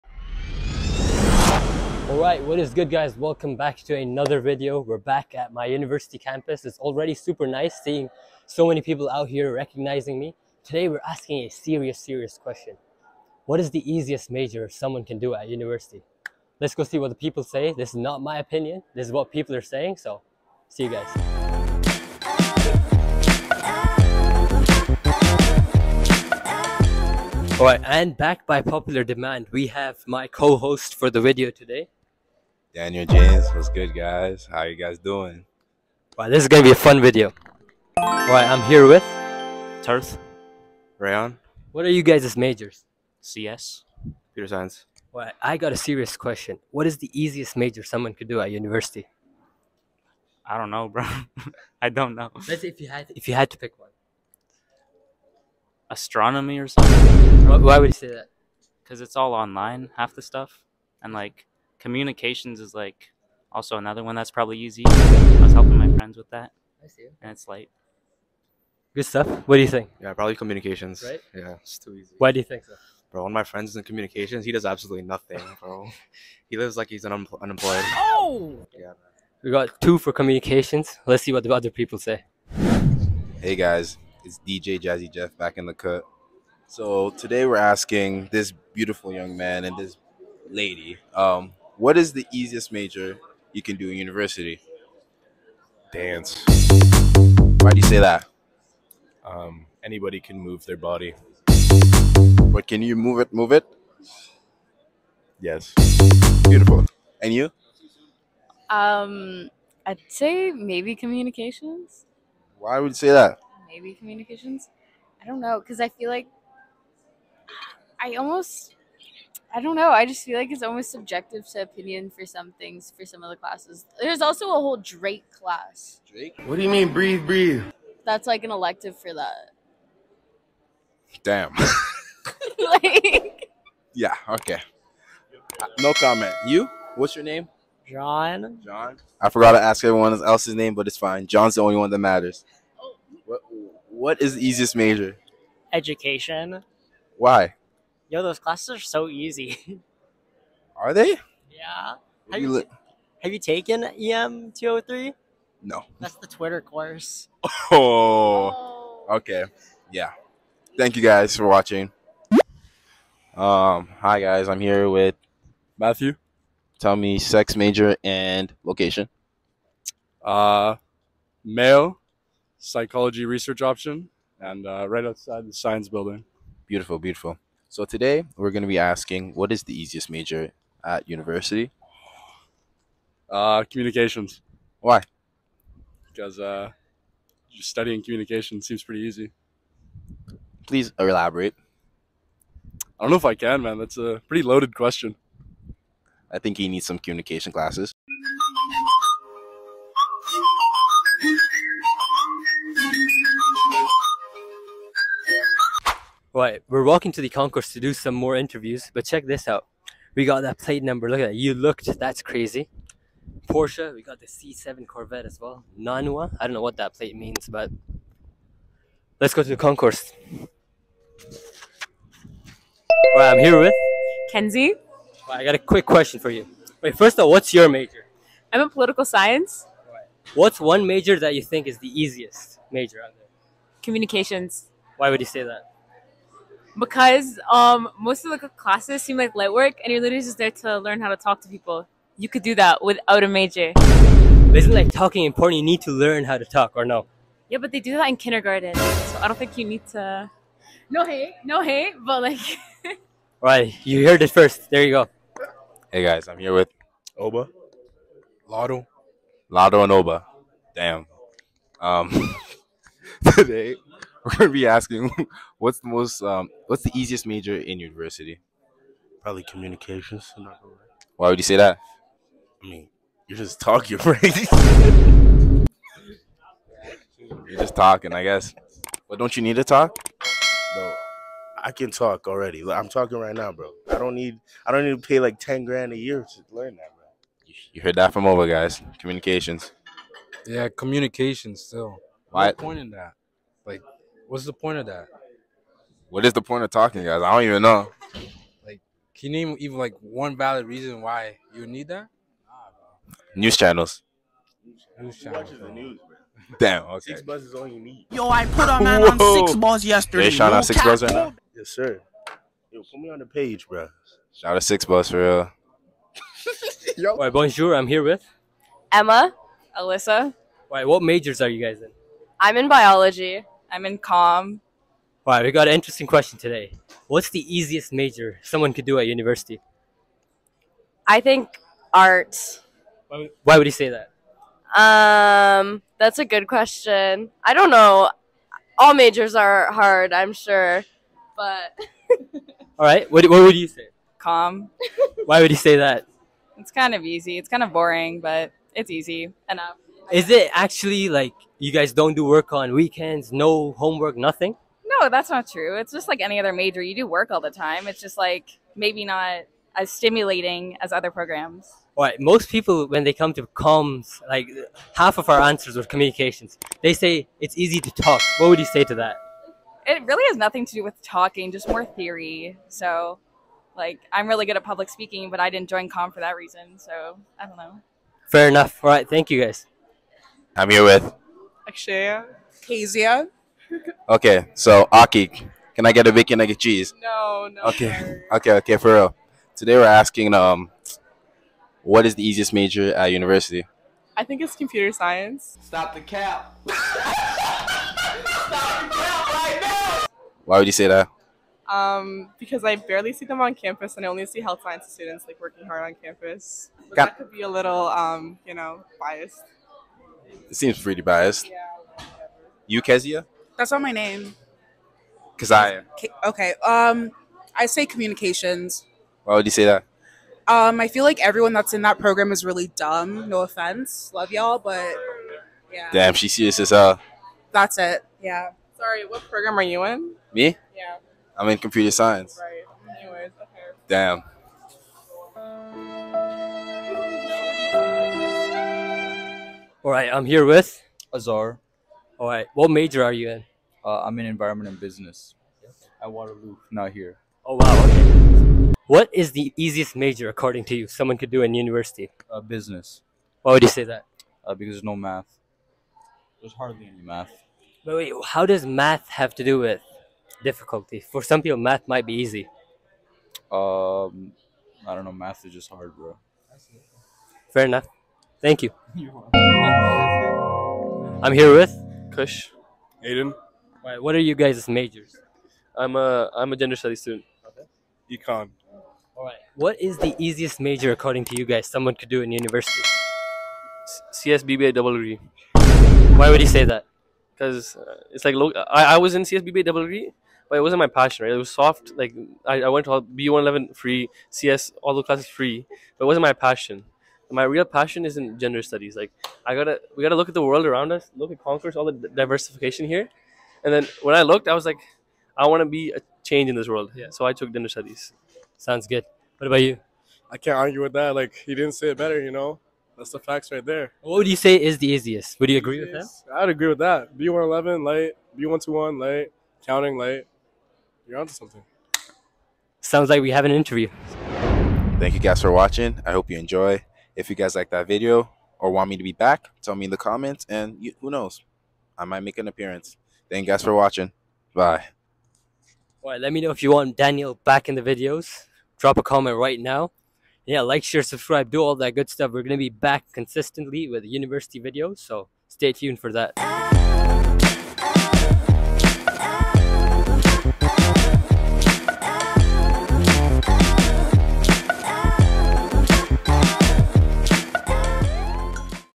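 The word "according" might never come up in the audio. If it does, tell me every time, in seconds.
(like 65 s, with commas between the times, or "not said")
450 s, 480 s.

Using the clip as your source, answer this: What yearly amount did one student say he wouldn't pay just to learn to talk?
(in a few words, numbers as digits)
Ten grand.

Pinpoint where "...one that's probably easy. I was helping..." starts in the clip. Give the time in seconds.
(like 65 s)
64 s.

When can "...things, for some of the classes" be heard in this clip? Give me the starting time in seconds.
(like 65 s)
122 s.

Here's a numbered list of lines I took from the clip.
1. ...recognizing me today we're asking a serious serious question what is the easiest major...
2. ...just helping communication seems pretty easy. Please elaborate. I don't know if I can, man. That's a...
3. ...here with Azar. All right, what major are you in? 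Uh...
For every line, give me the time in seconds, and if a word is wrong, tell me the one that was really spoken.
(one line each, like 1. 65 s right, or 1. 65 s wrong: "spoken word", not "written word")
1. 9 s right
2. 187 s wrong: "studying", not "helping"
3. 440 s right.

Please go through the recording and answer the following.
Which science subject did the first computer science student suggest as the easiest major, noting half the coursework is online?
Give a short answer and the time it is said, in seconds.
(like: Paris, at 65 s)
Astronomy, at 55 s.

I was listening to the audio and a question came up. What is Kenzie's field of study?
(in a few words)
Political science.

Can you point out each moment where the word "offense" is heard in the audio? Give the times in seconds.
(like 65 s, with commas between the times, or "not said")
423 s.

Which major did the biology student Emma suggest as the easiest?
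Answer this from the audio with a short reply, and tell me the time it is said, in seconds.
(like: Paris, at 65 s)
Art, at 331 s.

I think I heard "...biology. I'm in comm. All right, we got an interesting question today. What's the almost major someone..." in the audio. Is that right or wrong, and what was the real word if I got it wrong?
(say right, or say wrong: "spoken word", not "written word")
wrong: "easiest", not "almost".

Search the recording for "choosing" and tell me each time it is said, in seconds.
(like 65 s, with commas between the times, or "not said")
not said.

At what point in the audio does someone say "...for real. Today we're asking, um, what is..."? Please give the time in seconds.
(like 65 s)
388 s.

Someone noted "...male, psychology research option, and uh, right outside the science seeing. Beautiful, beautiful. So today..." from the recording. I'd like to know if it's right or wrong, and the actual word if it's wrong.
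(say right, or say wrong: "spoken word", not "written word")
wrong: "building", not "seeing".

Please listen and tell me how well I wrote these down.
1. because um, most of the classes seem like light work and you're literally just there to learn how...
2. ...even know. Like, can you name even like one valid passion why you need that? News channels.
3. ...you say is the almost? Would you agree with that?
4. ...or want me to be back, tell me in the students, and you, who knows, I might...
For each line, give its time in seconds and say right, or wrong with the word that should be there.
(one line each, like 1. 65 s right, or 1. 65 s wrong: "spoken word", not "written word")
1. 236 s right
2. 297 s wrong: "reason", not "passion"
3. 514 s wrong: "easiest", not "almost"
4. 528 s wrong: "comments", not "students".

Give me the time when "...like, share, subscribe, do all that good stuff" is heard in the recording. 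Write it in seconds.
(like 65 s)
540 s.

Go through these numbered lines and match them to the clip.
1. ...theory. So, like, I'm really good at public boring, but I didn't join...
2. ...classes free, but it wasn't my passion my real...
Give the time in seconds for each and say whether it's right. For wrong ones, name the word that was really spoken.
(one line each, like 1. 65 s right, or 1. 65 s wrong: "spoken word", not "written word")
1. 371 s wrong: "speaking", not "boring"
2. 495 s right.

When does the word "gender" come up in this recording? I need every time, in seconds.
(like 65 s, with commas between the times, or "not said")
476 s, 498 s, 507 s.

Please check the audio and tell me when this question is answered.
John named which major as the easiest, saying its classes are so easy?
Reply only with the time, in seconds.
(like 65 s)
145 s.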